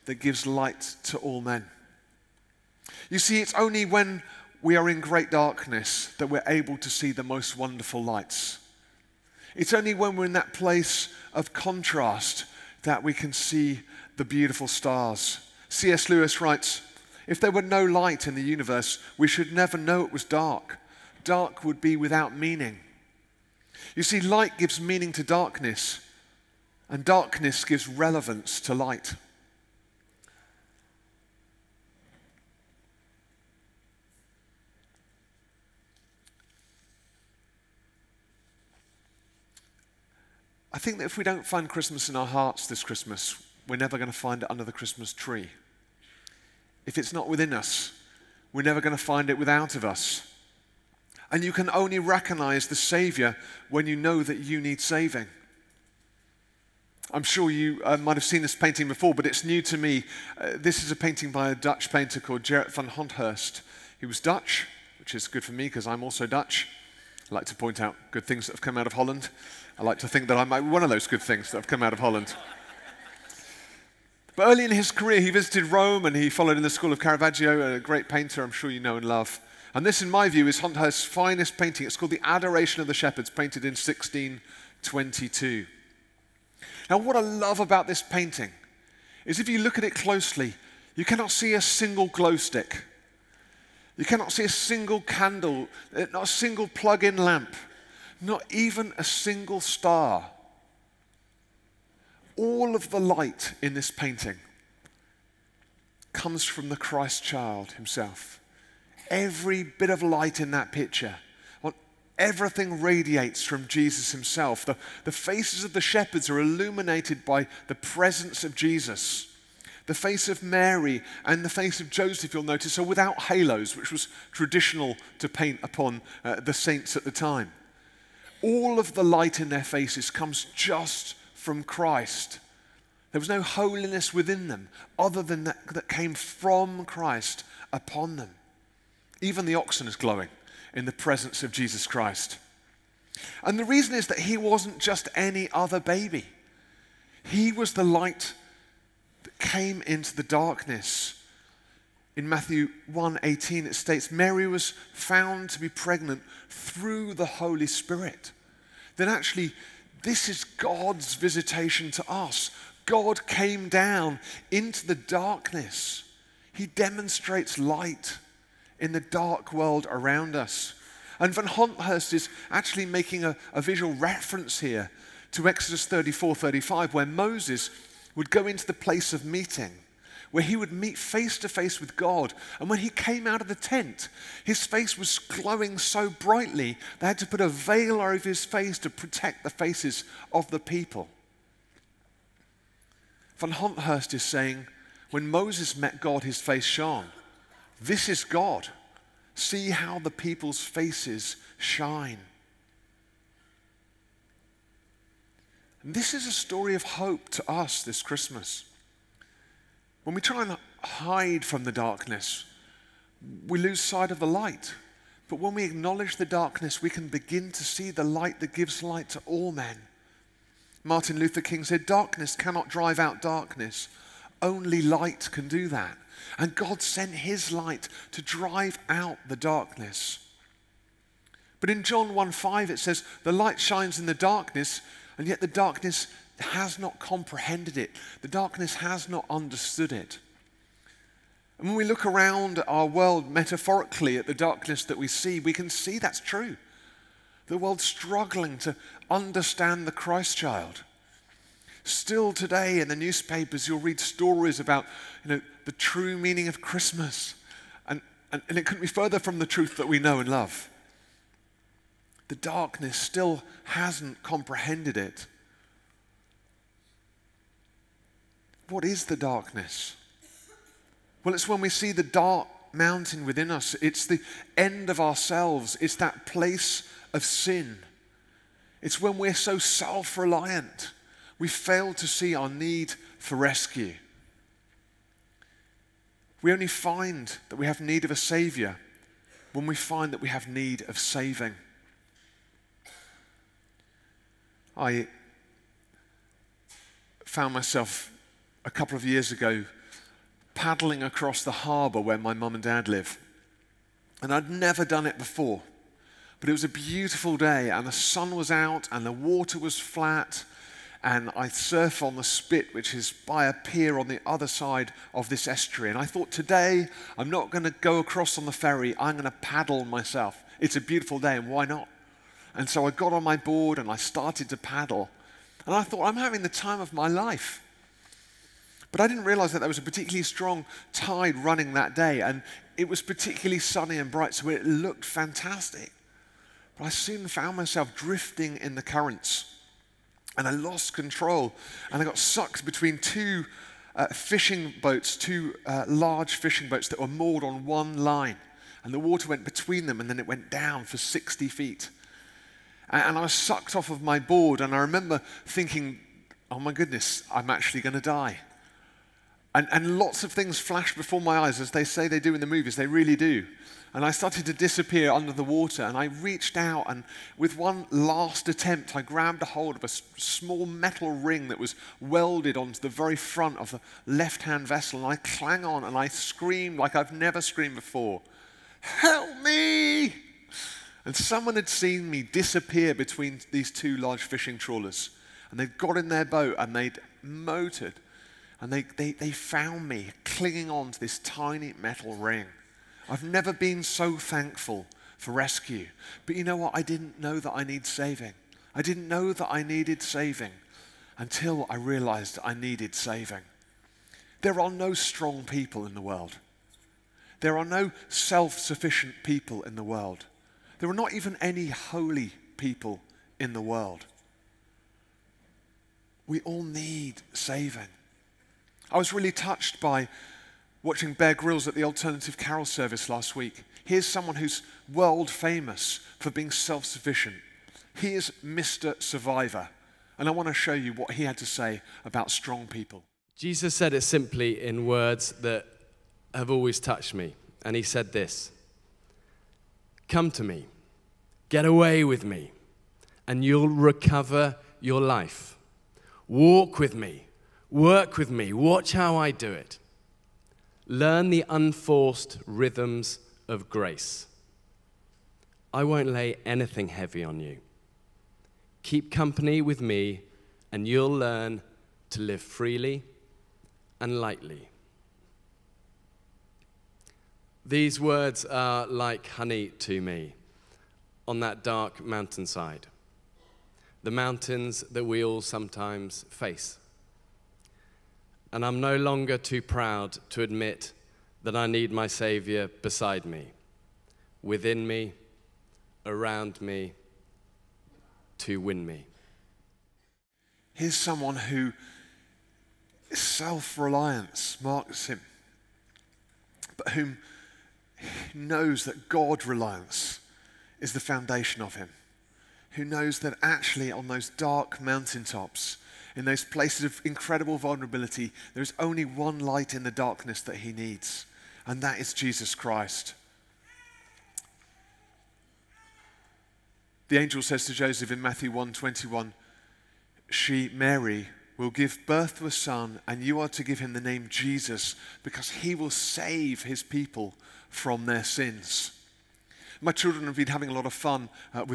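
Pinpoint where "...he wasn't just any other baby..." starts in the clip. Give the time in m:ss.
2:24.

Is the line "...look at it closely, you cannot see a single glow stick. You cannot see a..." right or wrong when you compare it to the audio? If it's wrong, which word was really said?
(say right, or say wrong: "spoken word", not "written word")
right.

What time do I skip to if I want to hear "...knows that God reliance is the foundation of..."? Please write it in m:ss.
8:18.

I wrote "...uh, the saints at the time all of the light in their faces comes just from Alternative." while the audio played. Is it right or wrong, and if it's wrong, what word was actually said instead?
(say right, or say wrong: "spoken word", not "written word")
wrong: "Christ", not "Alternative".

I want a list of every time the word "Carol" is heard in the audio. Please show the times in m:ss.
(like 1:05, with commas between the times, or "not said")
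7:02.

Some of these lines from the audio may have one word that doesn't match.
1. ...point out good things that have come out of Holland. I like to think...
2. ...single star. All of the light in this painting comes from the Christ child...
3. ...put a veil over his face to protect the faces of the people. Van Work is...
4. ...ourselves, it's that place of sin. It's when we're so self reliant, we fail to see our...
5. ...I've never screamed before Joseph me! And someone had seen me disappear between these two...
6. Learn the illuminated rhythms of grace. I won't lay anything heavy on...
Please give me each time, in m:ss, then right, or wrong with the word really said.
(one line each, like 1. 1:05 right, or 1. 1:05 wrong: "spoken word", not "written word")
1. 1:07 right
2. 1:39 right
3. 3:07 wrong: "Honthorst", not "Work"
4. 4:34 right
5. 6:16 wrong: "Help", not "Joseph"
6. 7:30 wrong: "unforced", not "illuminated".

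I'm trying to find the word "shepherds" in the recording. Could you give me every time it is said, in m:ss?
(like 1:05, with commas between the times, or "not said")
1:22, 1:55.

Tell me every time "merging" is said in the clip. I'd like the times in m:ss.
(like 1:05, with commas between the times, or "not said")
not said.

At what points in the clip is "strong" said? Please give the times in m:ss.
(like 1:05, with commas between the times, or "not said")
5:30, 6:44, 7:12.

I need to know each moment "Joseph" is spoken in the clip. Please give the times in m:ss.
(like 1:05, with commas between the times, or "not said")
2:01, 8:37.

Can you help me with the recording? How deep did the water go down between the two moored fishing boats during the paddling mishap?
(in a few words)
60 feet.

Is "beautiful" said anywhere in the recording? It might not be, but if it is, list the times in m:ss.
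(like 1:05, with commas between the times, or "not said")
0:14, 5:06, 5:20.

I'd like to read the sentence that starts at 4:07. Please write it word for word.
The world's struggling to understand the Christ child.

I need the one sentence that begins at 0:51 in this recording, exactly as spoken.
And you can only recognize the Savior when you know that you need saving.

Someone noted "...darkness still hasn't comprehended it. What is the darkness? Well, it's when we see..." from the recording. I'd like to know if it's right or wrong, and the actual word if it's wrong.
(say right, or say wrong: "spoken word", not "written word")
right.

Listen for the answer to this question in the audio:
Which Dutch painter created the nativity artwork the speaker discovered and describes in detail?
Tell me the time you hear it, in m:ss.
1:02.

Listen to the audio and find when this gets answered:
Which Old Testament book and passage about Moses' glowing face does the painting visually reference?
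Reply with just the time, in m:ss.
2:55.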